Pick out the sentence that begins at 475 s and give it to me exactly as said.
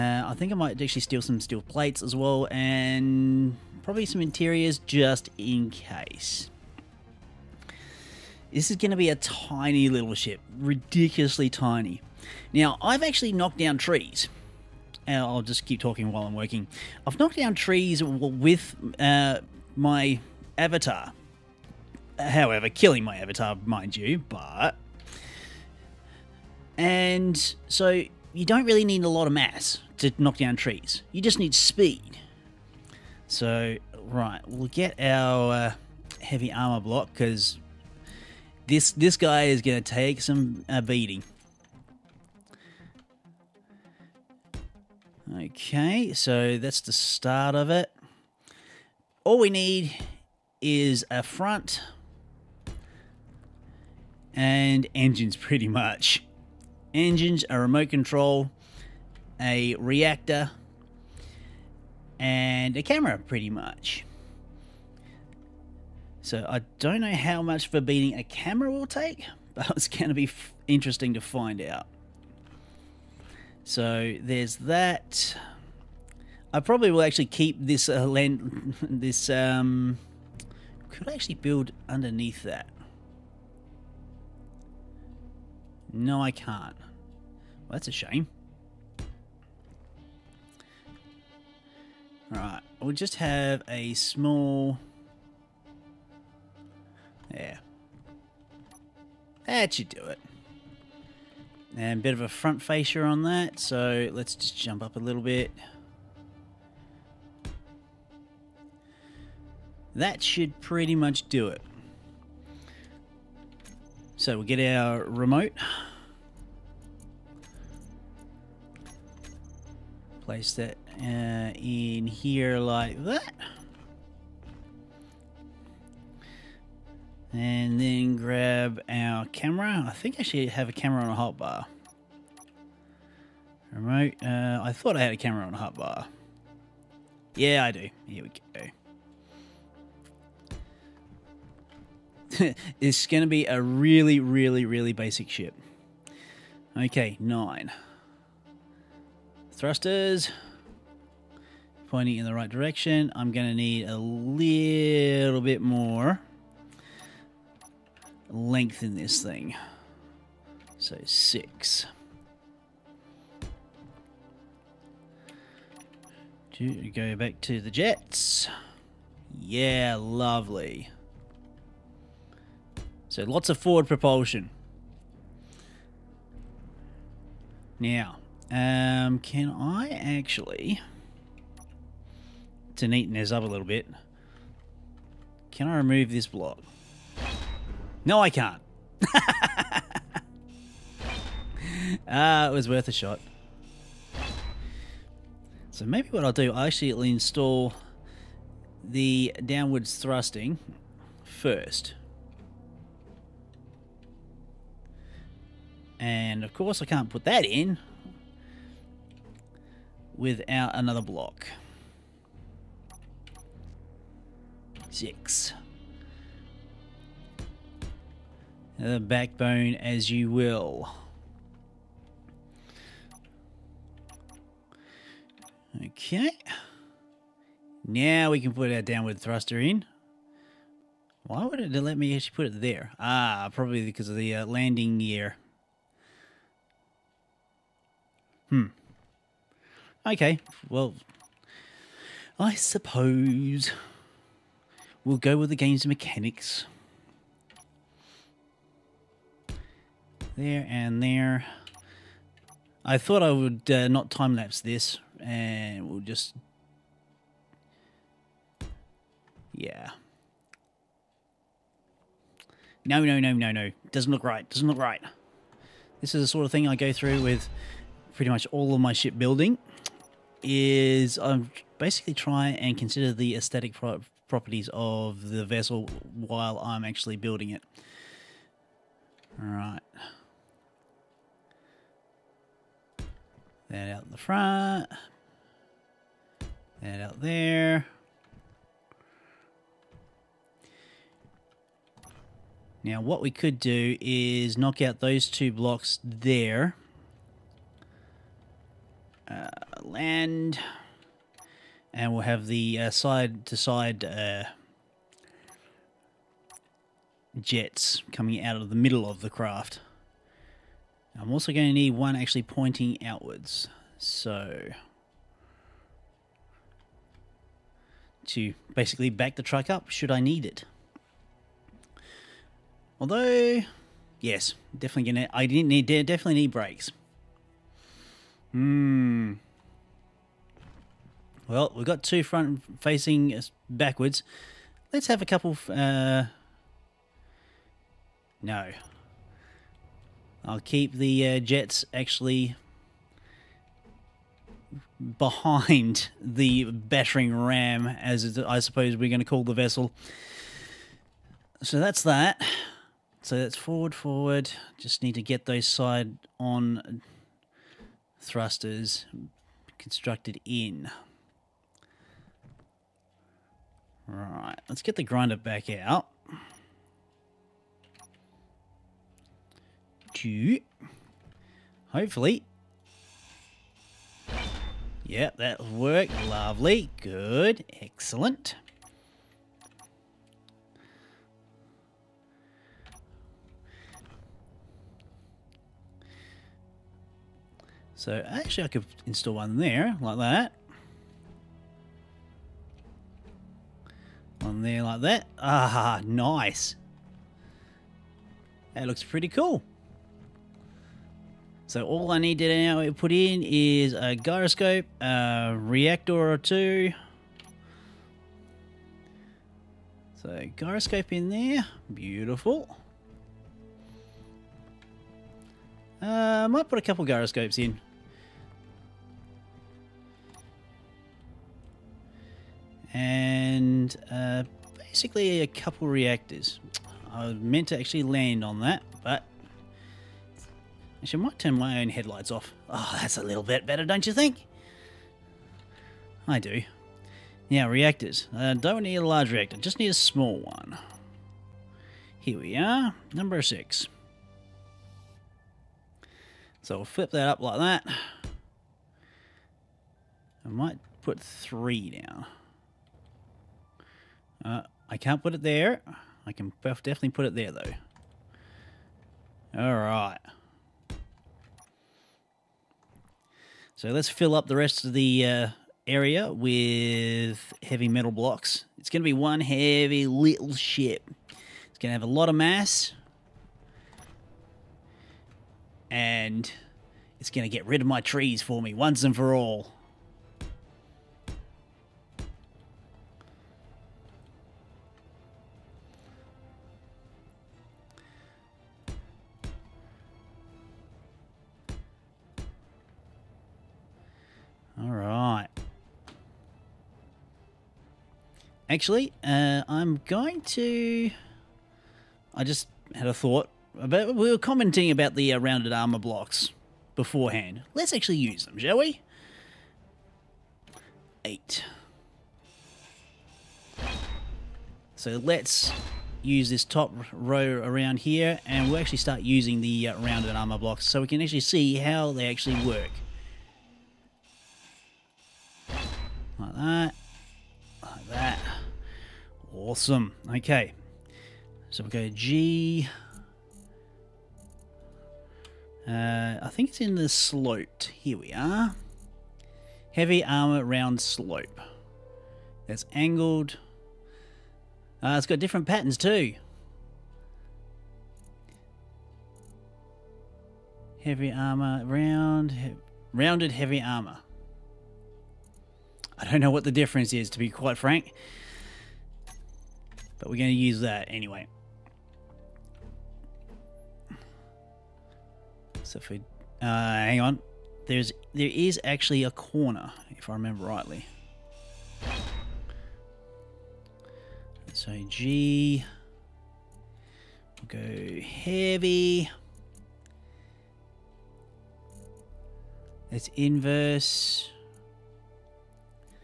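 And it's going to get rid of my trees for me once and for all.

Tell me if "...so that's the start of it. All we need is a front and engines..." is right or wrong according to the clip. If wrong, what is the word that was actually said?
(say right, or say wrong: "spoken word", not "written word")
right.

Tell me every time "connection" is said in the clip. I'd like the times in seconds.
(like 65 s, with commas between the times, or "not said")
not said.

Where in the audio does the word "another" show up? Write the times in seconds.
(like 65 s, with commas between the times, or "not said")
210 s.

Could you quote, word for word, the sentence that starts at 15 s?
Uh, I'll just keep talking while I'm working.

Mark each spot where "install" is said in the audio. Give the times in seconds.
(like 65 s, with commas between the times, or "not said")
197 s, 389 s.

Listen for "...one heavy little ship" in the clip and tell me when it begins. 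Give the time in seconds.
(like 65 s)
469 s.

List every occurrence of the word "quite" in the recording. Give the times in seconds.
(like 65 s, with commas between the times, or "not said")
557 s.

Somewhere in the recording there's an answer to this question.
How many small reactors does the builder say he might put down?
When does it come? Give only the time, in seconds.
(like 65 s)
451 s.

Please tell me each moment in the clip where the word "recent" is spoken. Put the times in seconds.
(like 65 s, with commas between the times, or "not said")
not said.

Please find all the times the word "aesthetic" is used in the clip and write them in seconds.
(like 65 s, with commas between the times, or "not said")
273 s.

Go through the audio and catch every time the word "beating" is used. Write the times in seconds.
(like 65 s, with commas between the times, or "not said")
40 s, 67 s.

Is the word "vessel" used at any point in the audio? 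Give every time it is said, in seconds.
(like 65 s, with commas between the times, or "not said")
275 s, 349 s.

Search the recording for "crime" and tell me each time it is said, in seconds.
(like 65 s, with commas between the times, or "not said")
not said.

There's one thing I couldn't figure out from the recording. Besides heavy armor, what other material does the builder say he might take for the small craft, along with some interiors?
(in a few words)
steel plates.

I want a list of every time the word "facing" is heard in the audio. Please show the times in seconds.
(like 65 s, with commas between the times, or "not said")
332 s.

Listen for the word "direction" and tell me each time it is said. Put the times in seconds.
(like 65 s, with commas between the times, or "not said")
152 s.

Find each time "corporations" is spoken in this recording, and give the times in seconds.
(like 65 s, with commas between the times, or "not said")
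not said.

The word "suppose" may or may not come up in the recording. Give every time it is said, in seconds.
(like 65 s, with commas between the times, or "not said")
242 s, 348 s.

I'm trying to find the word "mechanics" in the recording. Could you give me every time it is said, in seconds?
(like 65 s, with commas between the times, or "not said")
245 s.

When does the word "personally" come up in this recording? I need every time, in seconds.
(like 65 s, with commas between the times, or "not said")
not said.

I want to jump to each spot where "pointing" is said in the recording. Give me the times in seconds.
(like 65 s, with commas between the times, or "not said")
151 s, 312 s.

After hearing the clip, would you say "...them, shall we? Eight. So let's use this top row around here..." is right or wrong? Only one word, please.
right.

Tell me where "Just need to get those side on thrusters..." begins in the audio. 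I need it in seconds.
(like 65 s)
354 s.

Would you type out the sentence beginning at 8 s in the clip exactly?
This is going to be a tiny little ship.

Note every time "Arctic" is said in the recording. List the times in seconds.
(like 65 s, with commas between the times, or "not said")
not said.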